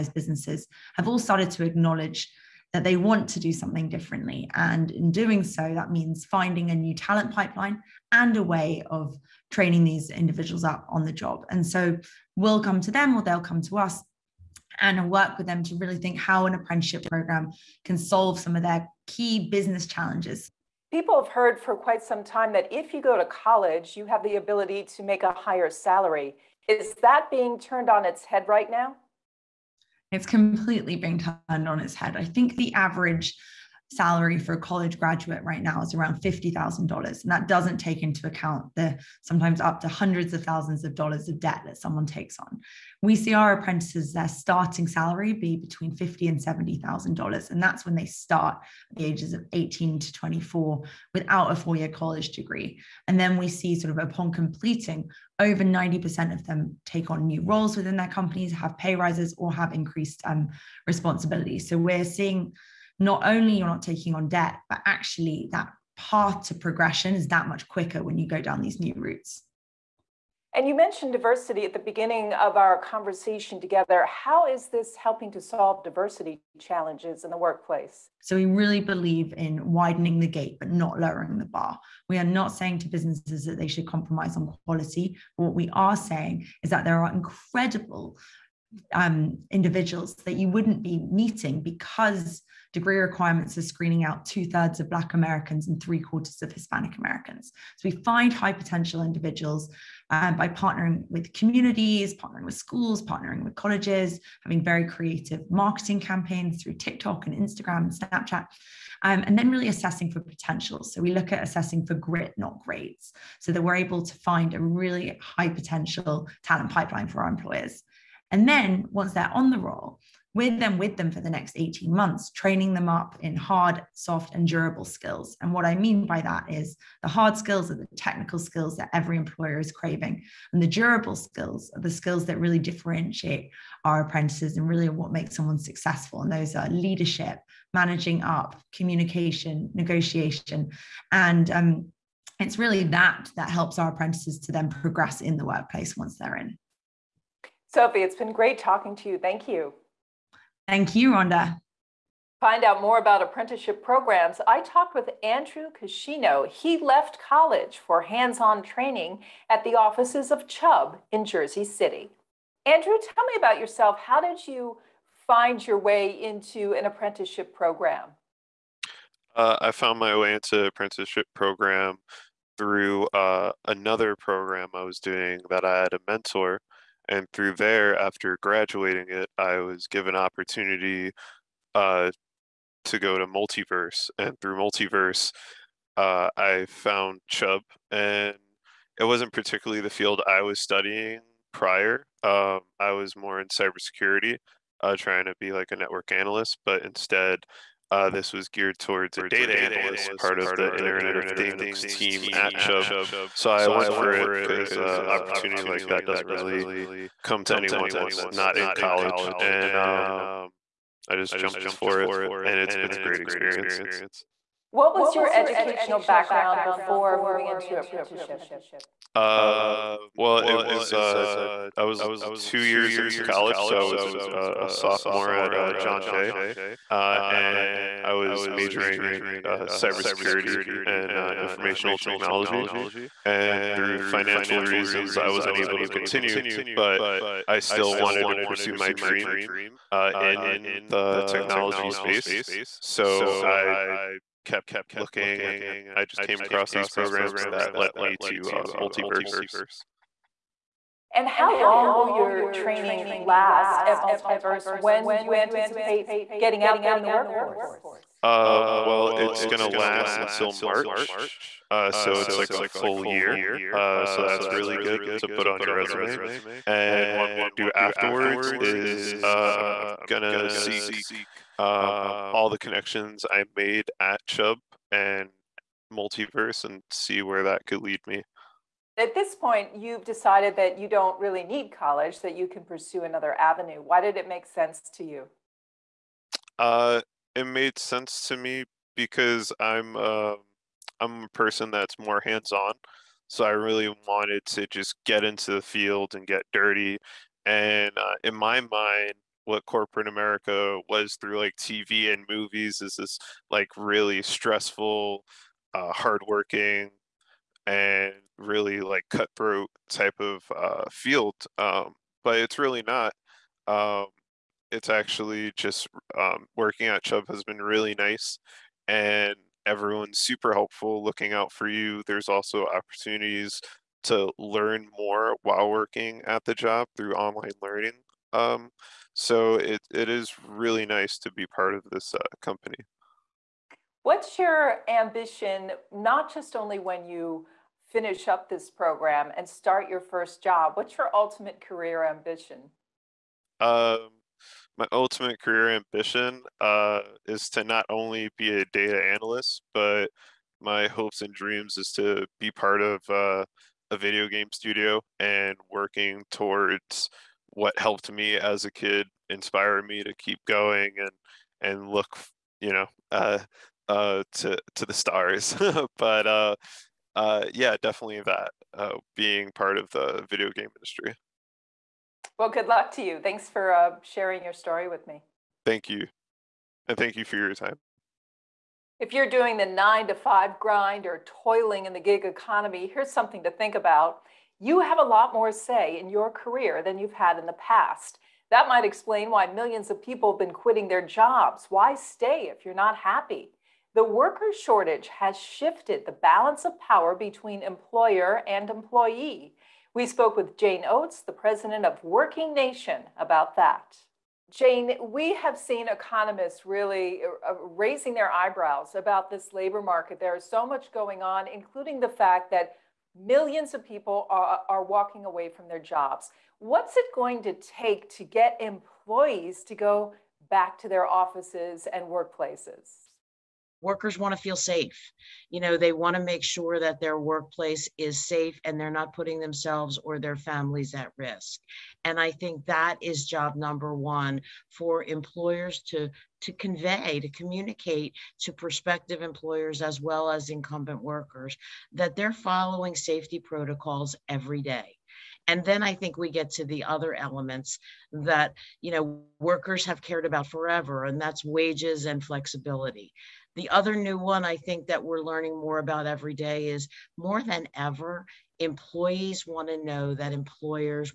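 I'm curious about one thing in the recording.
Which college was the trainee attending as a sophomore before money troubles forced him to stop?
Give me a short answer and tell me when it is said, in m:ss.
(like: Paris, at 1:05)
John Jay, at 3:45.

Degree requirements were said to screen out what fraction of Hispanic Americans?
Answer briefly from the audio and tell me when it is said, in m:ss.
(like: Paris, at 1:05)
three quarters, at 1:35.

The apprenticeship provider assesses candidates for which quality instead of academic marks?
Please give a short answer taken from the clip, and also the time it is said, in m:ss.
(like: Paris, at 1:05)
grit, at 1:51.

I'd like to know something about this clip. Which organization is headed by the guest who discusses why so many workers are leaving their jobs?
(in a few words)
Working Nation.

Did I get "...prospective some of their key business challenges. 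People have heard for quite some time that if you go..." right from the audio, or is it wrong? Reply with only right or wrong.
wrong.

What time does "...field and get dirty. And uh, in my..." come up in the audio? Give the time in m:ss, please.
4:55.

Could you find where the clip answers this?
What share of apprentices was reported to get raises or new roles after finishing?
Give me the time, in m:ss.
0:55.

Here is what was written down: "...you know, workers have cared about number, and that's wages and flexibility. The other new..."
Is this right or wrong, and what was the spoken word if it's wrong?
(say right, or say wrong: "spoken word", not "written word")
wrong: "forever", not "number".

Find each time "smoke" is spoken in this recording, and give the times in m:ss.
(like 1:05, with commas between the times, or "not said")
not said.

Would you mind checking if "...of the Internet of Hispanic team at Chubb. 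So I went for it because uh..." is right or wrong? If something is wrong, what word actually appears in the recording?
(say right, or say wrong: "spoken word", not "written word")
wrong: "Things", not "Hispanic".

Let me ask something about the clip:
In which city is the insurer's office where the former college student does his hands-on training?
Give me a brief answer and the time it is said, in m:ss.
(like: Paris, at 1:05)
Jersey City, at 2:41.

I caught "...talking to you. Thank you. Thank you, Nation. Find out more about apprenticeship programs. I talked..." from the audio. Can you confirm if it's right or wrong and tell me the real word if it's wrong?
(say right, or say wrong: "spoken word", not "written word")
wrong: "Rhonda", not "Nation".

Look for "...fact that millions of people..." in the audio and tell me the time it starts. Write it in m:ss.
6:52.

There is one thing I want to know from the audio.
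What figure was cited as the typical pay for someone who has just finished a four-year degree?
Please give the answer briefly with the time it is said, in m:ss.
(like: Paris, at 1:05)
$50,000, at 0:35.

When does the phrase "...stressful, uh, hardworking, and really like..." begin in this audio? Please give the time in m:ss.
5:04.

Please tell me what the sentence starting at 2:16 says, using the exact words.
And those are leadership, managing up, communication, negotiation.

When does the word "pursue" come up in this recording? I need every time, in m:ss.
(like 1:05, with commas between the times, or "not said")
3:58, 4:42.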